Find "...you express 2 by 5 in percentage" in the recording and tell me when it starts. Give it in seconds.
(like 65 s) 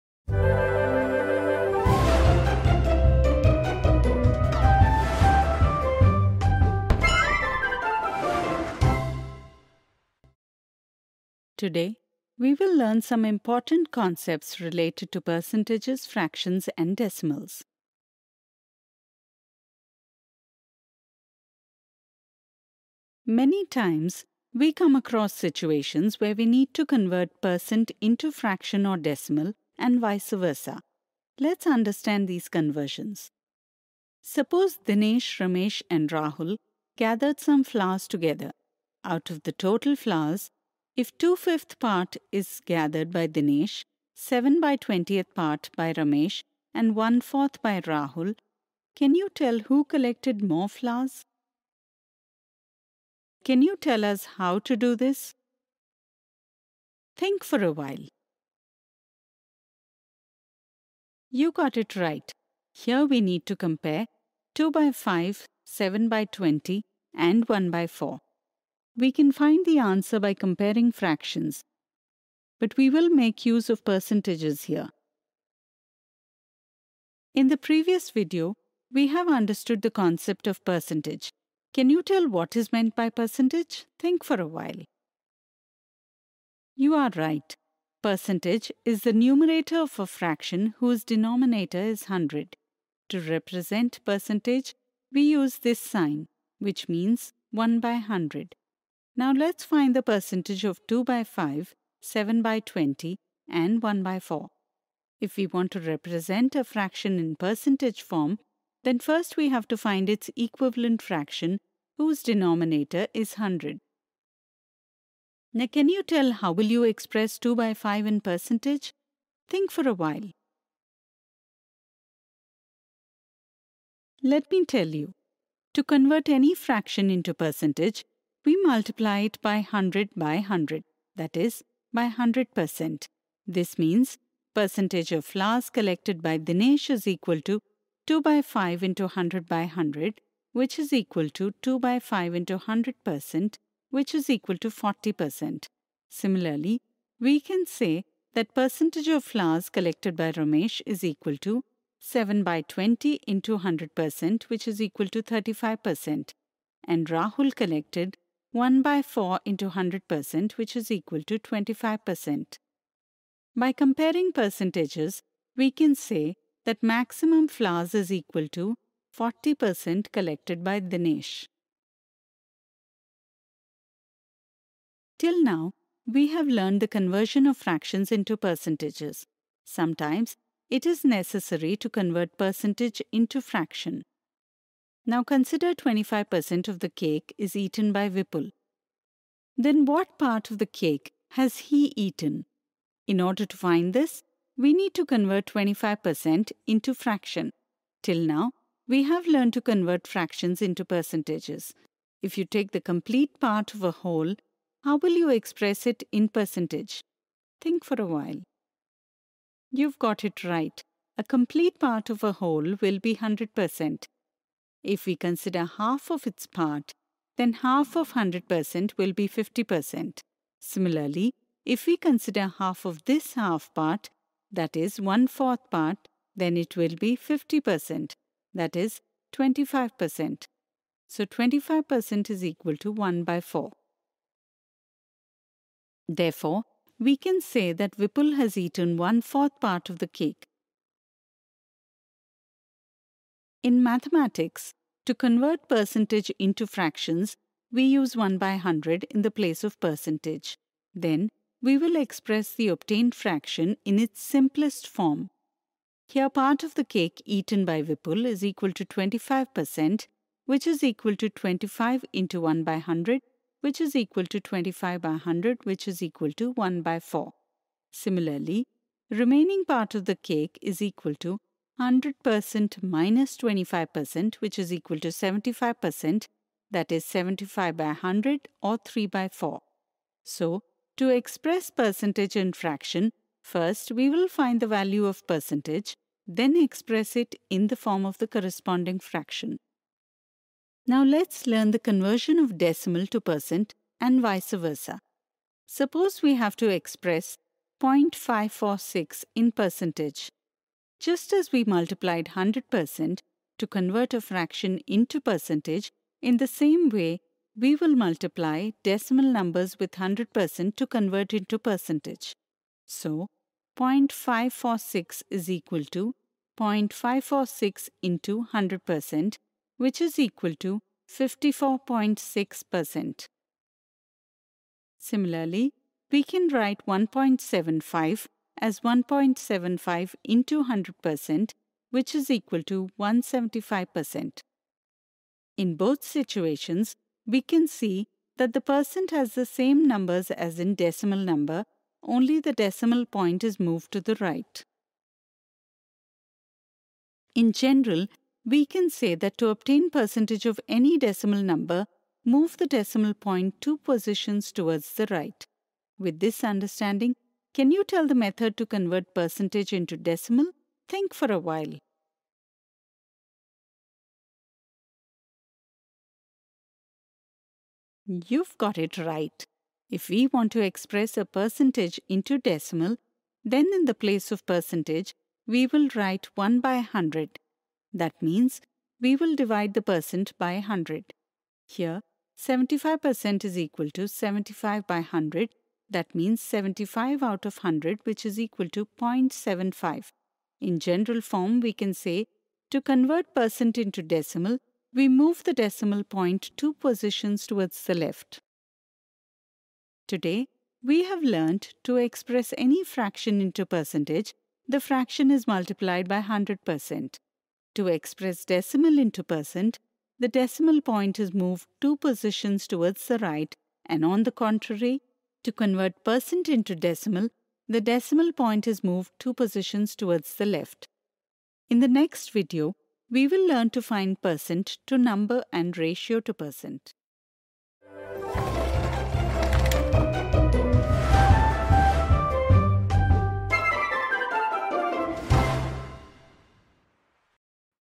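116 s.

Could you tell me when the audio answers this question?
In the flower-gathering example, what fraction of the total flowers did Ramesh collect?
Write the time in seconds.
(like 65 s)
44 s.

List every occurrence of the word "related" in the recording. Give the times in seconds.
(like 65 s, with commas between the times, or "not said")
14 s.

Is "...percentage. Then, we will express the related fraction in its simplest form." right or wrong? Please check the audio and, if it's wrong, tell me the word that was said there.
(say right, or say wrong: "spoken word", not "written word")
wrong: "obtained", not "related".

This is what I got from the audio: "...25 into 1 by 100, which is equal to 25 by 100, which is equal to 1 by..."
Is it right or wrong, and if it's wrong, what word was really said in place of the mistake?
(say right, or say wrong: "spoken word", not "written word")
right.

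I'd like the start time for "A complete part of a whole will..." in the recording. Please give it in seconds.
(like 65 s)
211 s.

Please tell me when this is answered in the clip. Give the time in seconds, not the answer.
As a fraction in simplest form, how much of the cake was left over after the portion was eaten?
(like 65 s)
278 s.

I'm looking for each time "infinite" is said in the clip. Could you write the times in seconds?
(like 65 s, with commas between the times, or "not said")
not said.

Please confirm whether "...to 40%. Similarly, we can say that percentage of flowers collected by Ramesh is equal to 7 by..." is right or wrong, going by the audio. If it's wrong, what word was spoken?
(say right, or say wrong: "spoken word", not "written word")
right.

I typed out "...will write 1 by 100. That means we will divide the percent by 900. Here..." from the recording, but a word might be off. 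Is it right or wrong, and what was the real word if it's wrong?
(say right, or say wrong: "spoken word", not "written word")
wrong: "100", not "900".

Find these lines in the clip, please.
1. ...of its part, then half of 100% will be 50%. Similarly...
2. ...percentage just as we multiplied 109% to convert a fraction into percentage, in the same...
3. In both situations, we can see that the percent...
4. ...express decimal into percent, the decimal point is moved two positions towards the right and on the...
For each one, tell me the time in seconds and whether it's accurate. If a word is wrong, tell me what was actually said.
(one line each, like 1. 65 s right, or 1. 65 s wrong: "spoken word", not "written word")
1. 216 s right
2. 299 s wrong: "100", not "109"
3. 335 s right
4. 407 s right.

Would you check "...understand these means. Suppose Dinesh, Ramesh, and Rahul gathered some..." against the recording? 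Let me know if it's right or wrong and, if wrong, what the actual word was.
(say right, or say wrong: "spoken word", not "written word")
wrong: "conversions", not "means".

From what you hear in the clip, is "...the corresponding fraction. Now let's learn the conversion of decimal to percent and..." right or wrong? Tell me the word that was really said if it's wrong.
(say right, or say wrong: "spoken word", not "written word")
right.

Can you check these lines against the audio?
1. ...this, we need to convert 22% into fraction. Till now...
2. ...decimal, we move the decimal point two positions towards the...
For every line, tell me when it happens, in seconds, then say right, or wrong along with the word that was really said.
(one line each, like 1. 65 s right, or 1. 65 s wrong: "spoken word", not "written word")
1. 193 s wrong: "25", not "22"
2. 394 s right.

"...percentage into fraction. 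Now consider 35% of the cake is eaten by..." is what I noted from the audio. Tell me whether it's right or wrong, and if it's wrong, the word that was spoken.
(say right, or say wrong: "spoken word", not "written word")
wrong: "25", not "35".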